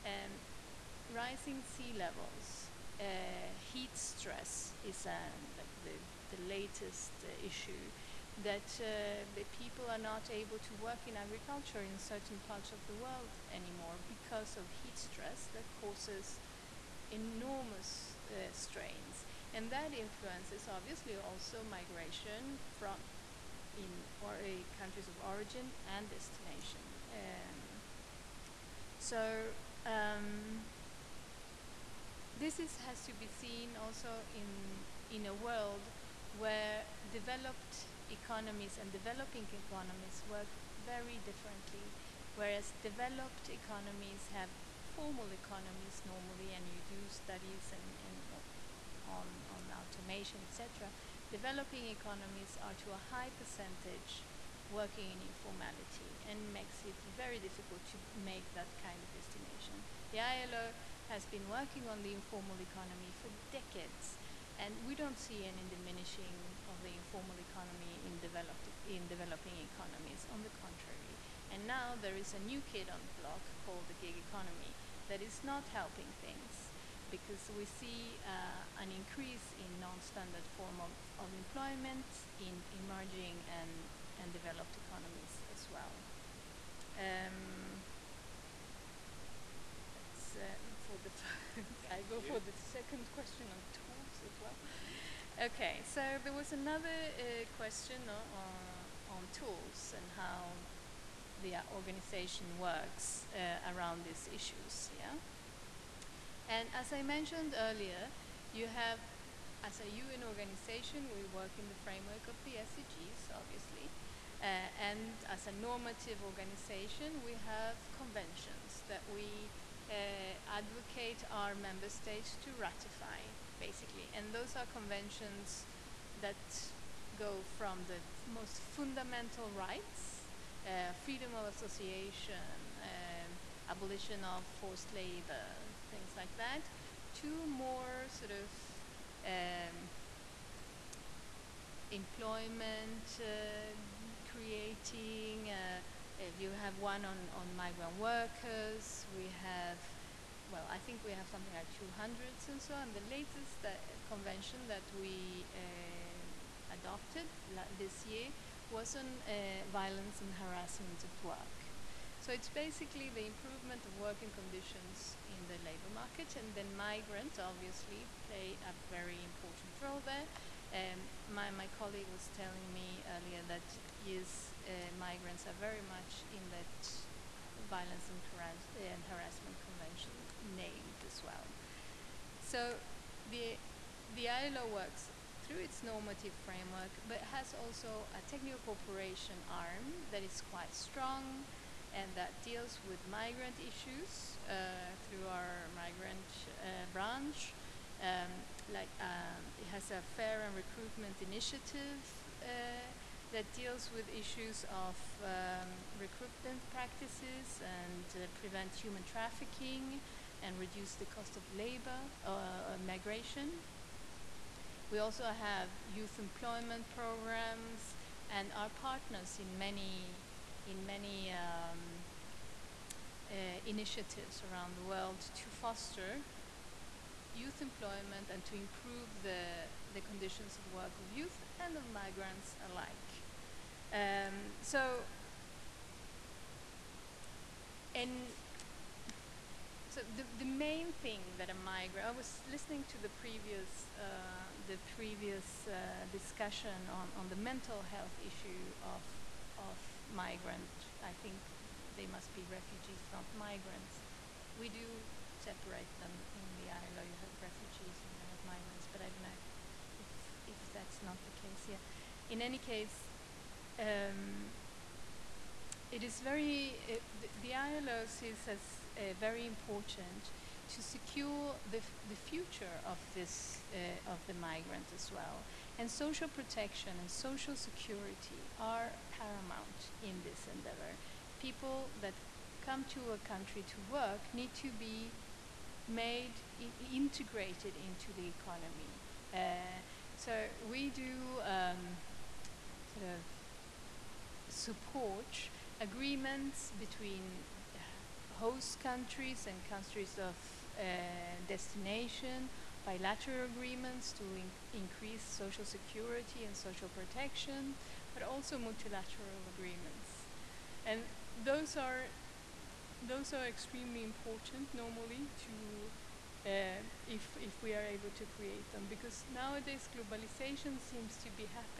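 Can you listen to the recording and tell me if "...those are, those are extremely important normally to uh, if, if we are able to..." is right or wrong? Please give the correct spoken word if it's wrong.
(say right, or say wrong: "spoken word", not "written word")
right.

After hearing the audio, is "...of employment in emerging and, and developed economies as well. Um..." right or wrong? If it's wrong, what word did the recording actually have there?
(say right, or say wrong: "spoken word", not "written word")
right.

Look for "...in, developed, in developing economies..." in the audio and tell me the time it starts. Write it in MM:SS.
01:08.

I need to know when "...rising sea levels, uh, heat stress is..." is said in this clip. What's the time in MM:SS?
00:01.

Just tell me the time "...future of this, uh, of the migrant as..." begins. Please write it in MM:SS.
04:32.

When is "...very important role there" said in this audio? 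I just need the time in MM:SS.
02:48.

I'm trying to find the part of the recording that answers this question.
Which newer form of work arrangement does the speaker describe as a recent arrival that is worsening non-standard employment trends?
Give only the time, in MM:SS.
01:13.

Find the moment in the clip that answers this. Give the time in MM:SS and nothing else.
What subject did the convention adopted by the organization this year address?
02:39.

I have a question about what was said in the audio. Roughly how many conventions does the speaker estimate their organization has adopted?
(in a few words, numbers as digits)
200.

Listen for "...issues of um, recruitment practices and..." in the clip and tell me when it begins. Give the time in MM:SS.
03:24.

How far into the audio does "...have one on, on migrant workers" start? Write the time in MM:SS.
02:26.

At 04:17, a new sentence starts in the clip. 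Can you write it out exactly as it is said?
You have refugees and you have migrants, but I don't know if, if that's not the case here.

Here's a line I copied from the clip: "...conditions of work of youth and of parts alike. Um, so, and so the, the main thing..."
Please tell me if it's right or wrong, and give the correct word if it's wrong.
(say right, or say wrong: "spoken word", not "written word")
wrong: "migrants", not "parts".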